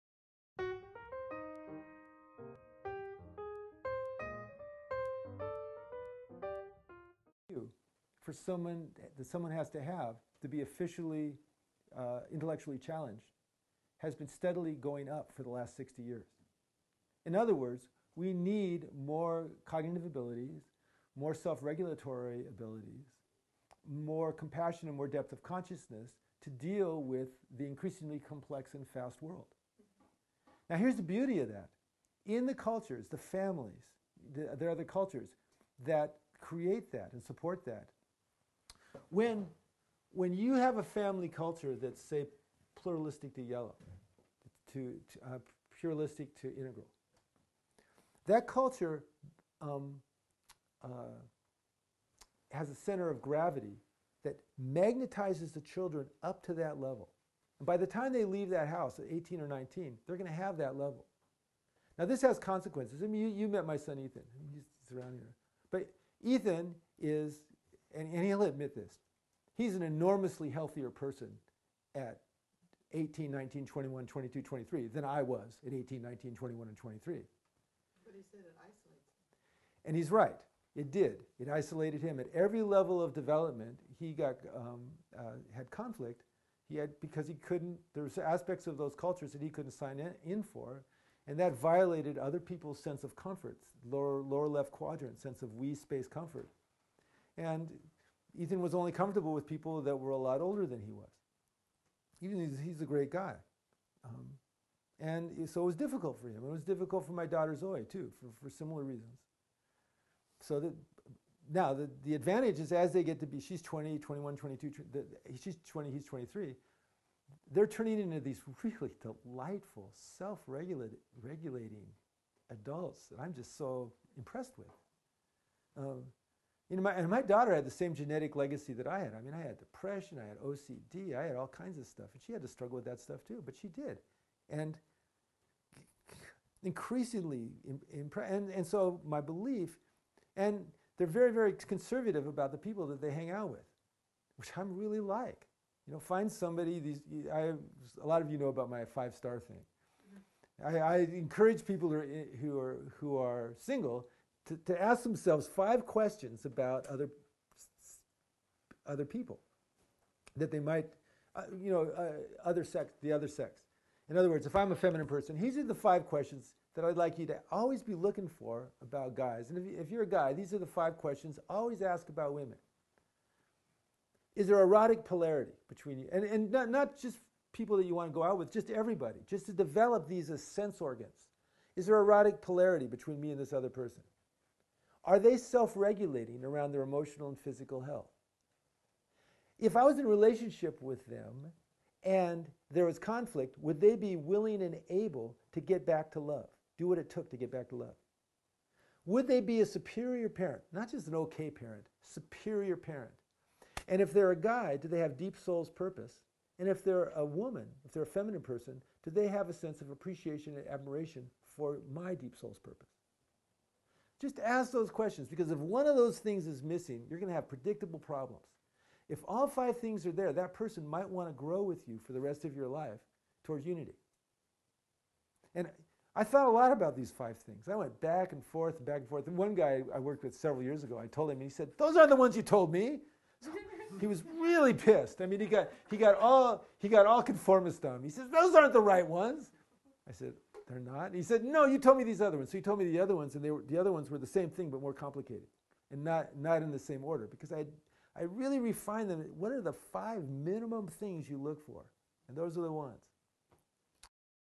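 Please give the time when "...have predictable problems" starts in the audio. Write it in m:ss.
3:37.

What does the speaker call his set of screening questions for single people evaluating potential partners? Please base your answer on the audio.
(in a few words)
five star thing.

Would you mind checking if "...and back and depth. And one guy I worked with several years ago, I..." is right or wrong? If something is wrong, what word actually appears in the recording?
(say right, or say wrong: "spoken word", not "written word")
wrong: "forth", not "depth".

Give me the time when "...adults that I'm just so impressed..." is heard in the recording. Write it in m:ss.
2:02.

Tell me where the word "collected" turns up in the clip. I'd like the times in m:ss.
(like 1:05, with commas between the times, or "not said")
not said.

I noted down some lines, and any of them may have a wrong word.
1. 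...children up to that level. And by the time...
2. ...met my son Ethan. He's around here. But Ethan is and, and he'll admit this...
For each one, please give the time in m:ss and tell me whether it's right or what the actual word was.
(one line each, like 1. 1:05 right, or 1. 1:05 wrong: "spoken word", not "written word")
1. 0:55 right
2. 1:03 right.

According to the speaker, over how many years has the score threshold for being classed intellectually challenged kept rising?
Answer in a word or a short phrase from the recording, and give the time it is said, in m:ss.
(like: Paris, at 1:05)
60 years, at 0:15.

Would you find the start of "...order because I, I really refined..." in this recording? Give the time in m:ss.
4:07.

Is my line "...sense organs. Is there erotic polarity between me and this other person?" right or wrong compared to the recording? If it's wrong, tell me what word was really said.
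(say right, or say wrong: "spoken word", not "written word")
right.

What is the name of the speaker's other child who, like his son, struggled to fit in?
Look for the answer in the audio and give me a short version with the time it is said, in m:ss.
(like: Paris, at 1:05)
Zoe, at 1:47.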